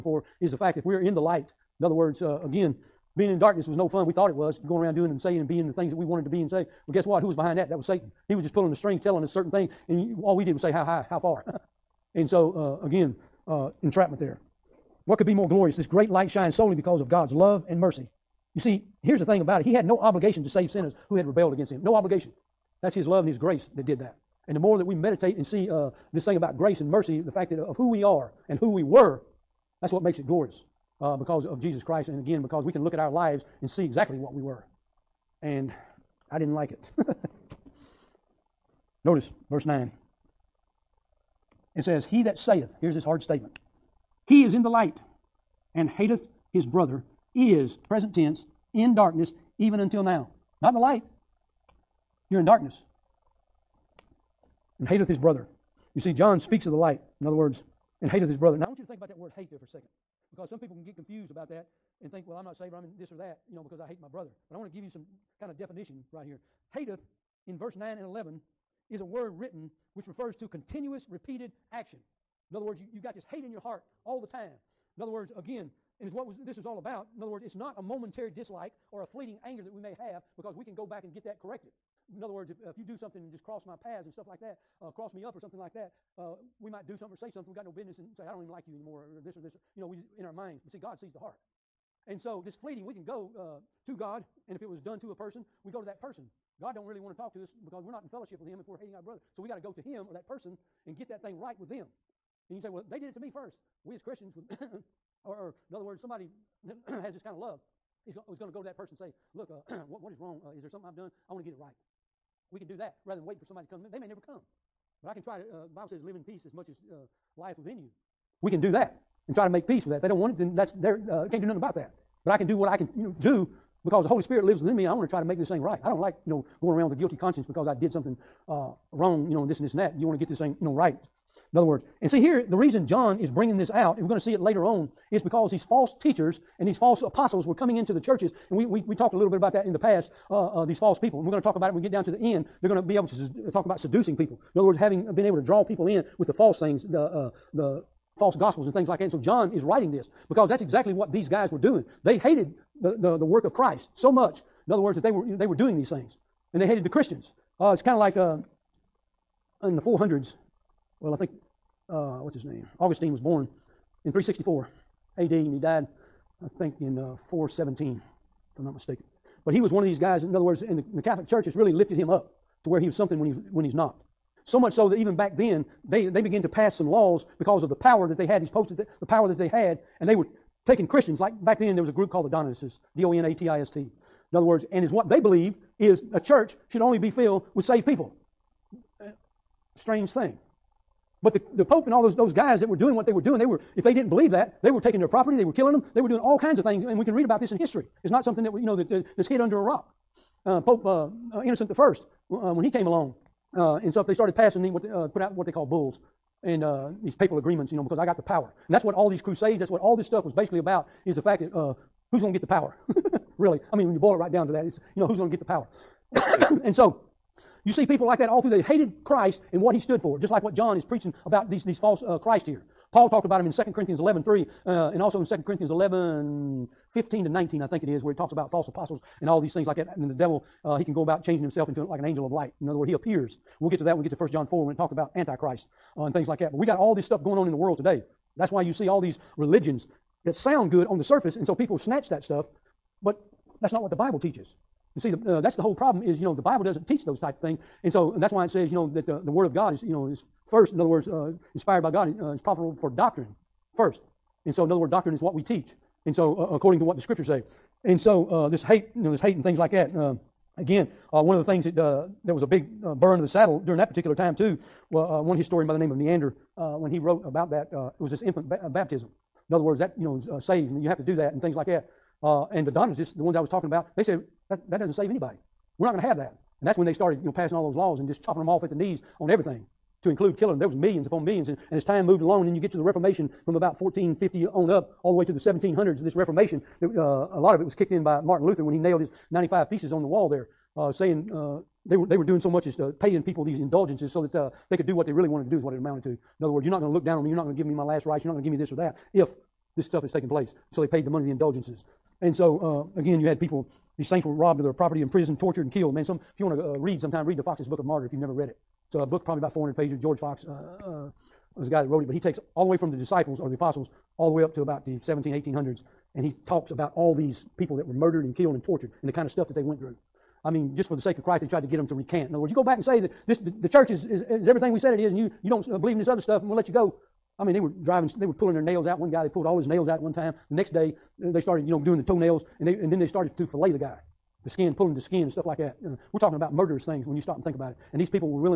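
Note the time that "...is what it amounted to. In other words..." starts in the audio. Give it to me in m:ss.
4:55.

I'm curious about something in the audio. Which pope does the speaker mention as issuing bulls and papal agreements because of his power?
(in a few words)
Innocent I.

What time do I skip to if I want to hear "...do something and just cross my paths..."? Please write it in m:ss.
1:22.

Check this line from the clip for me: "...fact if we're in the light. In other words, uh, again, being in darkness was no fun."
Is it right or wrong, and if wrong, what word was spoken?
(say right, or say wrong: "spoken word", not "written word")
right.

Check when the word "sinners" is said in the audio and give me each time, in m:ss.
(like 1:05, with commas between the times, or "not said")
0:20.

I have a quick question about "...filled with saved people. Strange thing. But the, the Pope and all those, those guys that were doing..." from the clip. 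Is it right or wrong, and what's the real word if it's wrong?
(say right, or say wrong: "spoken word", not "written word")
right.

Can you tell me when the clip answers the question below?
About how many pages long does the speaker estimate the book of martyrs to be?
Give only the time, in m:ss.
5:09.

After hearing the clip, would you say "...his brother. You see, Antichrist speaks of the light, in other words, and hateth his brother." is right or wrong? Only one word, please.
wrong.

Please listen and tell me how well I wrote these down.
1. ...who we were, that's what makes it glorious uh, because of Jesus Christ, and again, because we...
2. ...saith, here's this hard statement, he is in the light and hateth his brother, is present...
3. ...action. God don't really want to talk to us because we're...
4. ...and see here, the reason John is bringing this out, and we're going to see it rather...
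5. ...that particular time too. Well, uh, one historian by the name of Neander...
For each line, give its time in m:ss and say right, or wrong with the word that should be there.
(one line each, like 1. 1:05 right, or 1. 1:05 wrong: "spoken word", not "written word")
1. 0:28 right
2. 0:42 right
3. 1:36 wrong: "person", not "action"
4. 2:12 wrong: "later", not "rather"
5. 4:23 right.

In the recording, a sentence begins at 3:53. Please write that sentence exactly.
We'll get to that when we get to 1 John 4 when it talked about Antichrist uh, and things like that.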